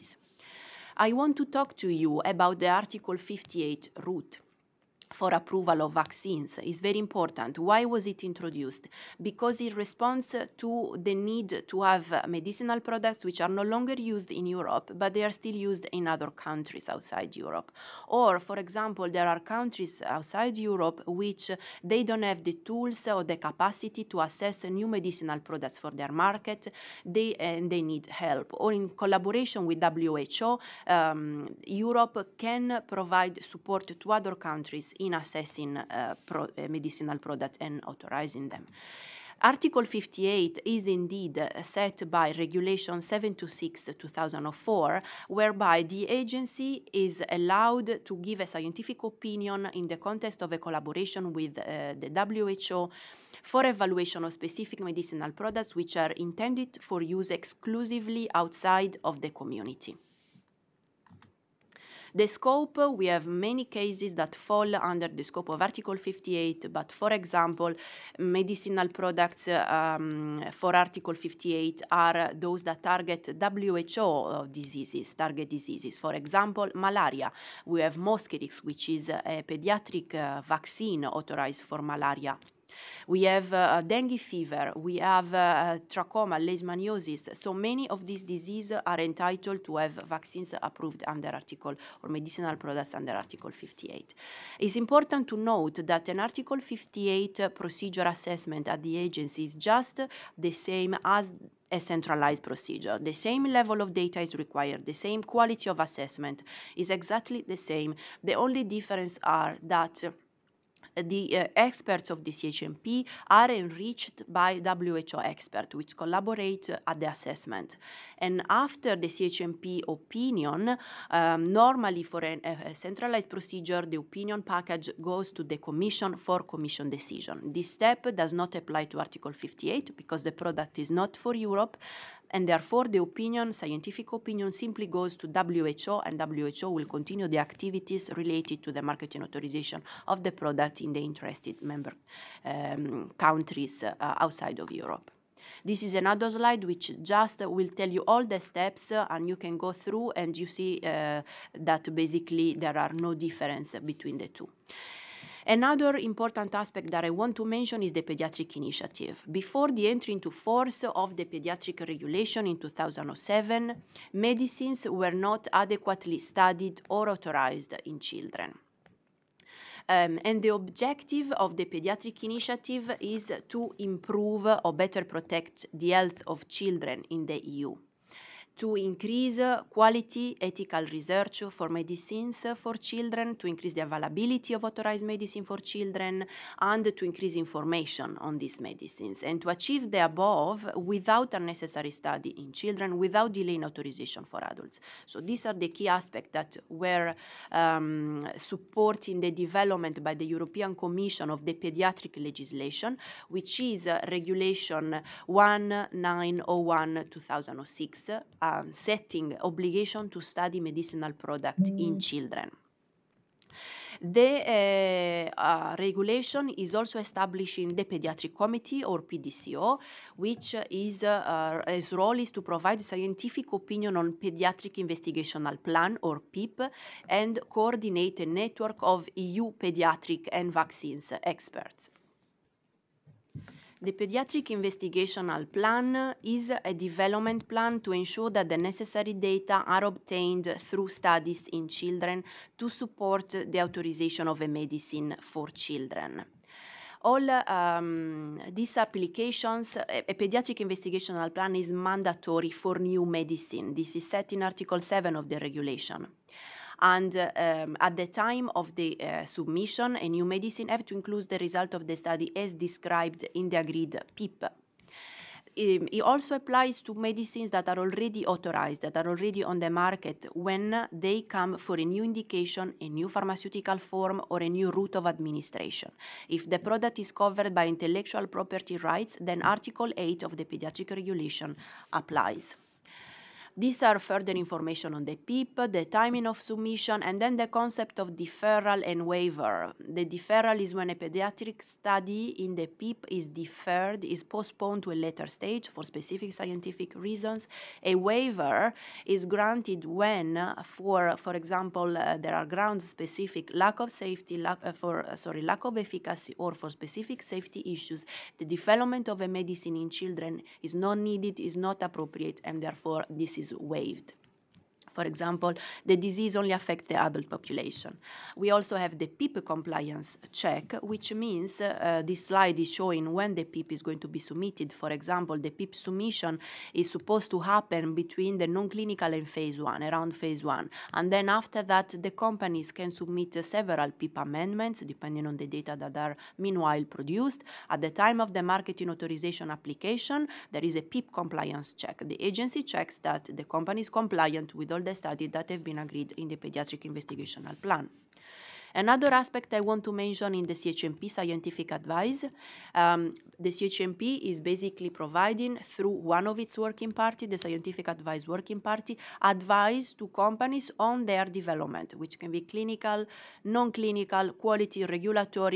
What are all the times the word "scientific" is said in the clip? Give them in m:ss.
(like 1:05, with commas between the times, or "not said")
0:48, 2:13, 3:42, 4:56, 5:51, 5:57.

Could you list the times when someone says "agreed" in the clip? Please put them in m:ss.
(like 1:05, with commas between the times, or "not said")
4:23, 5:45.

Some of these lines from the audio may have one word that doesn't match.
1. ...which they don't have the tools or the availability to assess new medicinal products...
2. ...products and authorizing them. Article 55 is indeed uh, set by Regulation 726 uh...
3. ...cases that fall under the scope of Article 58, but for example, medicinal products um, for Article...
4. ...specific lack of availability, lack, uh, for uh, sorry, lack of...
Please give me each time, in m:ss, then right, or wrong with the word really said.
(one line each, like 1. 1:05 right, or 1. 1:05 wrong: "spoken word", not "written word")
1. 0:21 wrong: "capacity", not "availability"
2. 0:37 wrong: "58", not "55"
3. 1:03 right
4. 5:02 wrong: "safety", not "availability".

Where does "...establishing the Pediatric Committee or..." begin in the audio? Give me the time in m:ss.
3:36.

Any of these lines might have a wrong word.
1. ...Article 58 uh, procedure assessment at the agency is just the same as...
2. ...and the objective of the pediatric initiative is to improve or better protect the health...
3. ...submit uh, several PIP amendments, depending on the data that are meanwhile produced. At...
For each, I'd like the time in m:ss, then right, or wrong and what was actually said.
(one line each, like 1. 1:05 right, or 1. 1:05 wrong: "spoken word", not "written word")
1. 1:36 right
2. 2:50 right
3. 5:32 right.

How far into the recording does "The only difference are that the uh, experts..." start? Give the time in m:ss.
1:48.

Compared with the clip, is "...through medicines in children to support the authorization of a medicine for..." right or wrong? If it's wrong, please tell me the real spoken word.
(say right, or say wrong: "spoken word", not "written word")
wrong: "studies", not "medicines".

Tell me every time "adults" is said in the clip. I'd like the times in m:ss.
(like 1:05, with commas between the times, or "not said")
3:14, 5:17.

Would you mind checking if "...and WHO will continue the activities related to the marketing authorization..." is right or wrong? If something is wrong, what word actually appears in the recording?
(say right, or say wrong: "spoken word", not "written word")
right.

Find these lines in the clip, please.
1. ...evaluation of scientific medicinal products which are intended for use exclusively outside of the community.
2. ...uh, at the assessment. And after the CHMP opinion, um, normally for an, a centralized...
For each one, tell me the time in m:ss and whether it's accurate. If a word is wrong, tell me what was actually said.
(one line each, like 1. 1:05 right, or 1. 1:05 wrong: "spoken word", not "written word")
1. 0:53 wrong: "specific", not "scientific"
2. 1:56 right.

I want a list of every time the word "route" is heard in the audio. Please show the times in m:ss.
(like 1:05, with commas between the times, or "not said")
0:04, 4:34.